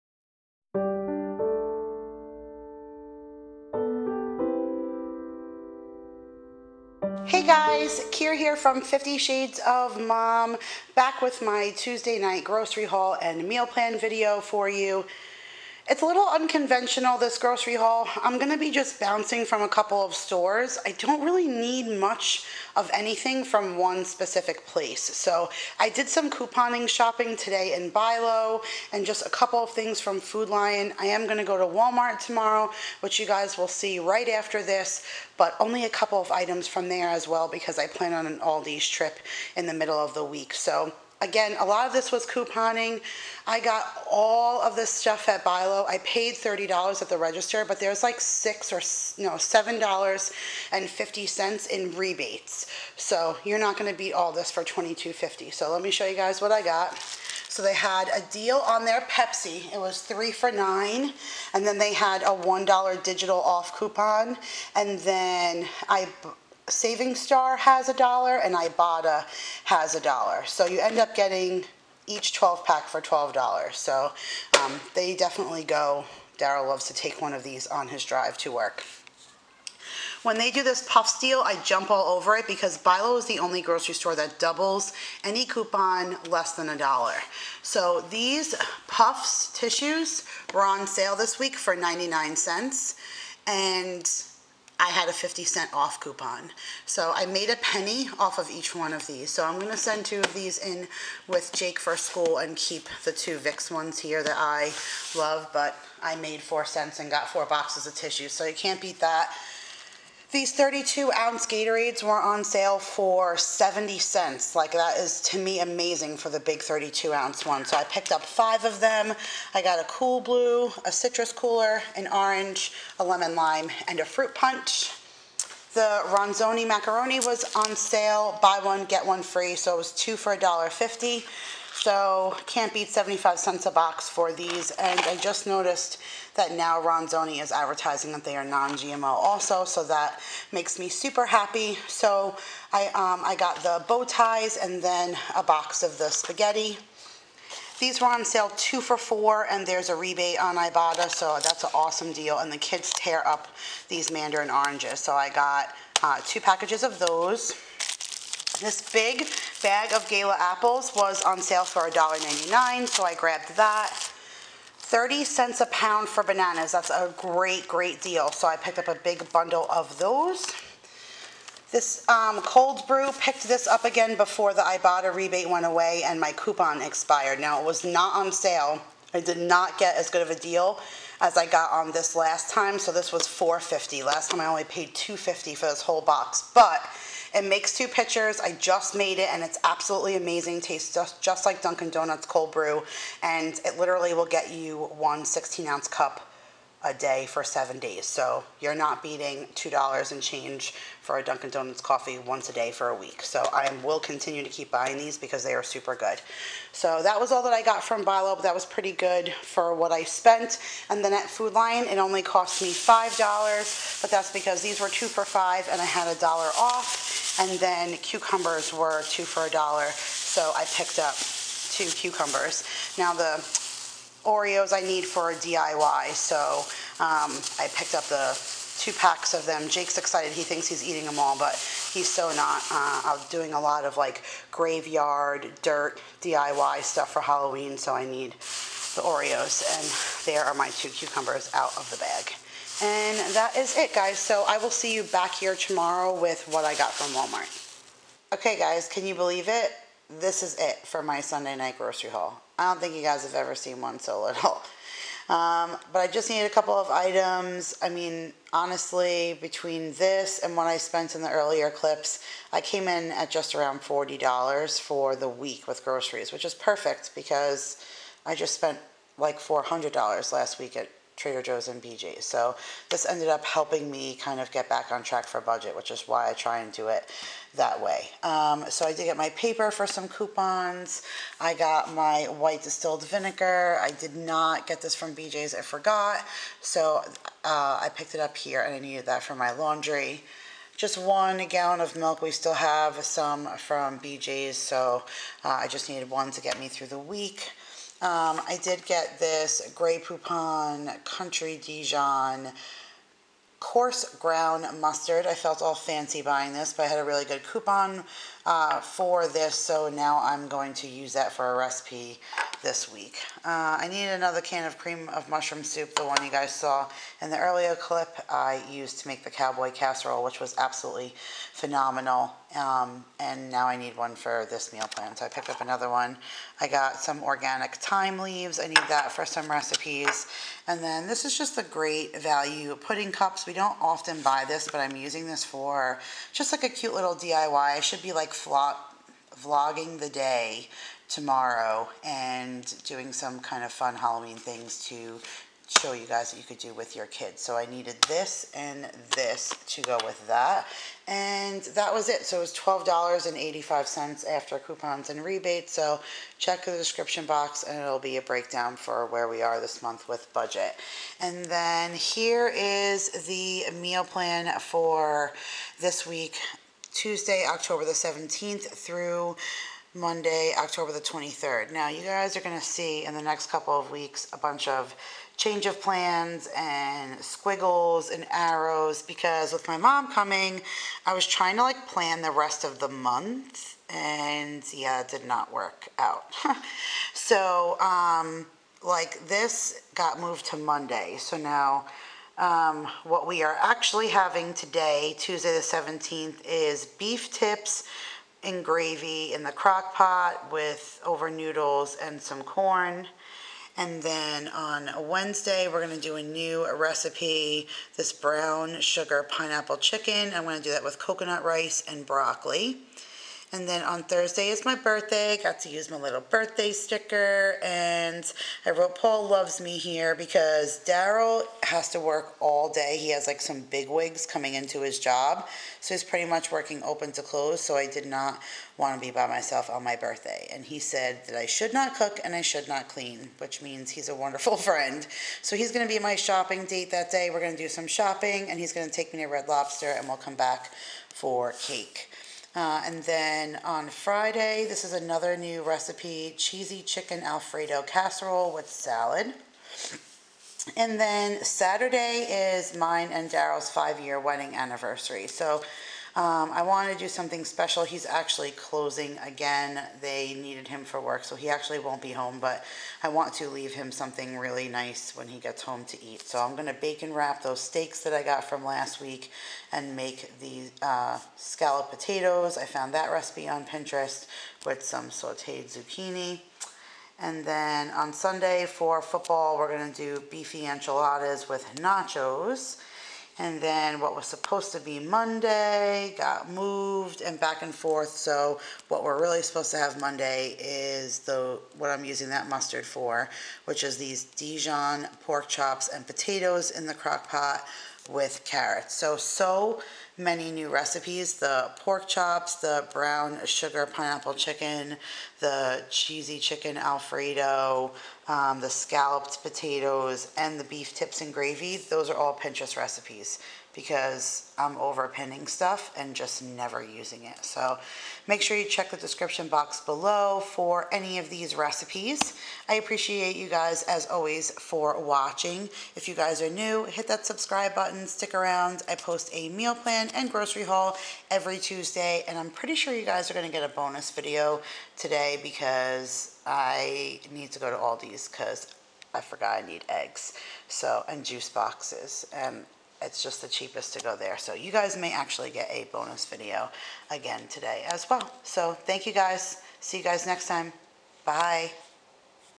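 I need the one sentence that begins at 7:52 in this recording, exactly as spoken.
I found that recipe on Pinterest with some sauteed zucchini.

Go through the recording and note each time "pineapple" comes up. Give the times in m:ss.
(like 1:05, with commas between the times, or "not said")
6:49, 8:23.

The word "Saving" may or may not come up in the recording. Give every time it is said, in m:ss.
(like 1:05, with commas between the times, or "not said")
1:06.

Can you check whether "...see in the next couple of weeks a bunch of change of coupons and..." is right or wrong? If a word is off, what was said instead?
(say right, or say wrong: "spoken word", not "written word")
wrong: "plans", not "coupons".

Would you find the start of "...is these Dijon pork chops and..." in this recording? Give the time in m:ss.
8:13.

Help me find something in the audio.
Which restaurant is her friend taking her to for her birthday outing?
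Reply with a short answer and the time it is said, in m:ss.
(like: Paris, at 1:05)
Red Lobster, at 7:19.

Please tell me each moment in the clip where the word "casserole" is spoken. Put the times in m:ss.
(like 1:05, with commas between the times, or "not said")
5:19, 7:27.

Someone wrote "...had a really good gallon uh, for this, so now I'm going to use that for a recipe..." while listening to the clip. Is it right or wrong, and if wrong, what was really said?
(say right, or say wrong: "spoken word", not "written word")
wrong: "coupon", not "gallon".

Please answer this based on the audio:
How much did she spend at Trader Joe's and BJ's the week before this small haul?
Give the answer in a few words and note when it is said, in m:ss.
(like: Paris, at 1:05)
$400, at 4:29.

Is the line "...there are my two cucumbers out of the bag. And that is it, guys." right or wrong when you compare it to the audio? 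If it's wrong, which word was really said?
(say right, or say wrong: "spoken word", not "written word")
right.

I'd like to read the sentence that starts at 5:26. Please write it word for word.
I got some organic thyme leaves.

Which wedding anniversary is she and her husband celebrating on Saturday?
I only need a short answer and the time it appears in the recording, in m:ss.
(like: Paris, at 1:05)
5 year, at 7:33.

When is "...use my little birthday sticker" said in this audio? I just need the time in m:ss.
6:55.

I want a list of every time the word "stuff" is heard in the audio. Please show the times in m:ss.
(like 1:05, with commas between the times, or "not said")
0:44, 3:56, 8:35.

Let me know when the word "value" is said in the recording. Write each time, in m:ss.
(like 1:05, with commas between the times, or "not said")
5:32.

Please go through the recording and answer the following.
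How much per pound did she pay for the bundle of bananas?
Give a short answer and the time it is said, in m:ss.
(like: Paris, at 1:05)
30 cents, at 2:44.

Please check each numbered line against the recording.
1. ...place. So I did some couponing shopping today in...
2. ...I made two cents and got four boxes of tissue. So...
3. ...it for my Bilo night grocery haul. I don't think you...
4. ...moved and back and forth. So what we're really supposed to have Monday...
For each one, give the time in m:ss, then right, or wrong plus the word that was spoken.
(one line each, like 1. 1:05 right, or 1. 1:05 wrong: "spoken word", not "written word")
1. 0:24 right
2. 1:46 wrong: "four", not "two"
3. 4:10 wrong: "Sunday", not "Bilo"
4. 8:06 right.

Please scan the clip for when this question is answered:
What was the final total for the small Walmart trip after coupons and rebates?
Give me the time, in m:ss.
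5:52.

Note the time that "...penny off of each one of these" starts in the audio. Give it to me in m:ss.
1:37.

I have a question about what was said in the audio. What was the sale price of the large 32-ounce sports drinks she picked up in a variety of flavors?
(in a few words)
70 cents.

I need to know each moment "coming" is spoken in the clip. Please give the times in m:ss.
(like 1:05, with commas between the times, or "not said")
6:20, 7:04.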